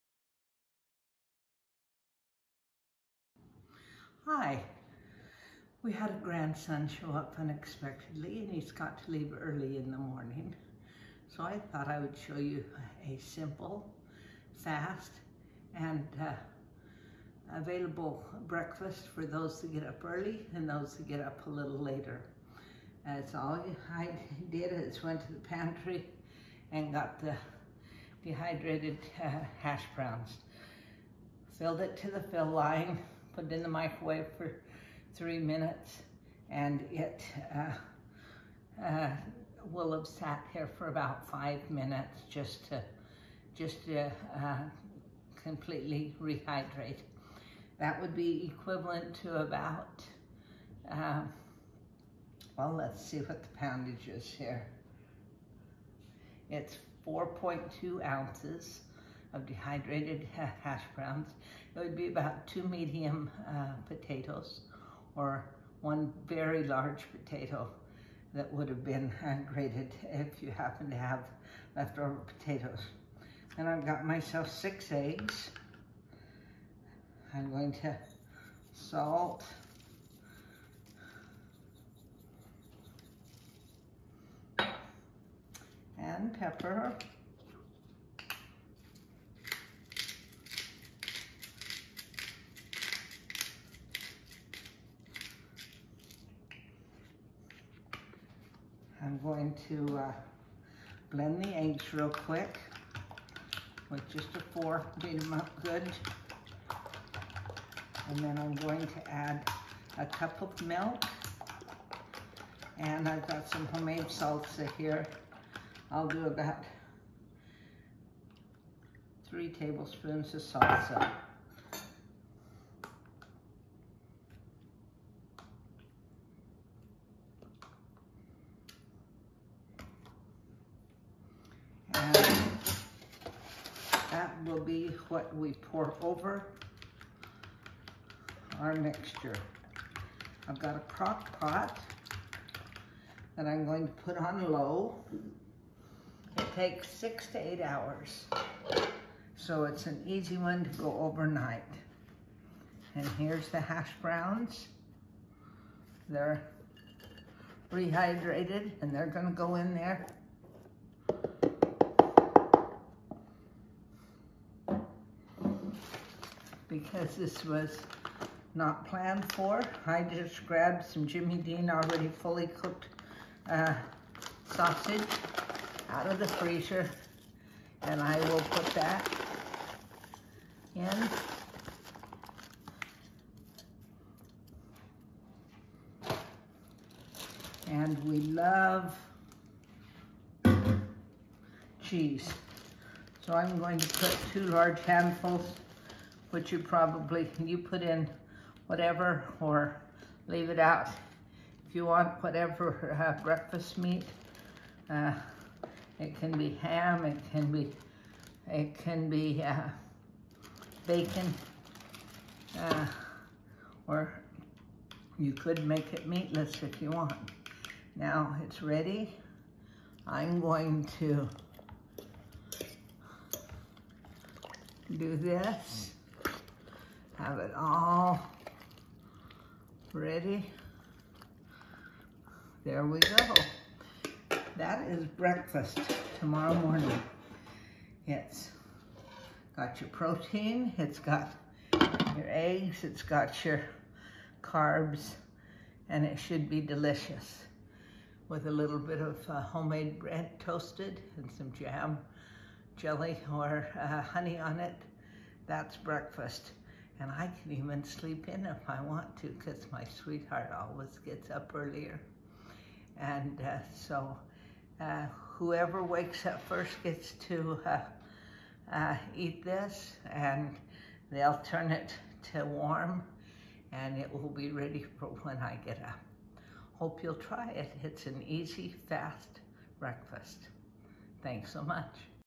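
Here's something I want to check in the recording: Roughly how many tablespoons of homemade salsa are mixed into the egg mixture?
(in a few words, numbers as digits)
3.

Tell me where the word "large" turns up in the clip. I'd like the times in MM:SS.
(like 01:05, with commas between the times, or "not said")
01:06, 03:14.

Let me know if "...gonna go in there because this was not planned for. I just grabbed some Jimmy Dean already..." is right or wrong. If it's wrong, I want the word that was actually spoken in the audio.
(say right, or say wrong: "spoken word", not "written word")
right.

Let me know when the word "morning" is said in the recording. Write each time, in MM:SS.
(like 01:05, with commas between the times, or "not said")
00:09, 03:56.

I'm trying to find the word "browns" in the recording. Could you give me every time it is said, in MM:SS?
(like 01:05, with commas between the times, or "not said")
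00:29, 01:00, 02:34.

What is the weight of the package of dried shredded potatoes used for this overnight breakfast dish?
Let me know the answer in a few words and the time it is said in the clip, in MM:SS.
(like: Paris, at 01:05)
4.2 ounces, at 00:57.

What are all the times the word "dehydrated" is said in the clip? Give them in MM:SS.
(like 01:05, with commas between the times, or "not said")
00:28, 00:59.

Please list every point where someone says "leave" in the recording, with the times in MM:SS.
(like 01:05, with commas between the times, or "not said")
00:09, 03:20.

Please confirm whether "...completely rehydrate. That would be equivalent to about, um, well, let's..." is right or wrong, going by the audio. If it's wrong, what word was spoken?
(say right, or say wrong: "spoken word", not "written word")
right.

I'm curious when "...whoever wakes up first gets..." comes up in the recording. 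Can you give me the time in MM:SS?
04:25.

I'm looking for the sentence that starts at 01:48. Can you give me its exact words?
And then I'm going to add a cup of milk.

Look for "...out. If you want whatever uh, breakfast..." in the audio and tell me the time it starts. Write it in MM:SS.
03:20.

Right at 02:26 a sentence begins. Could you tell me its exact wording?
It takes six to eight hours.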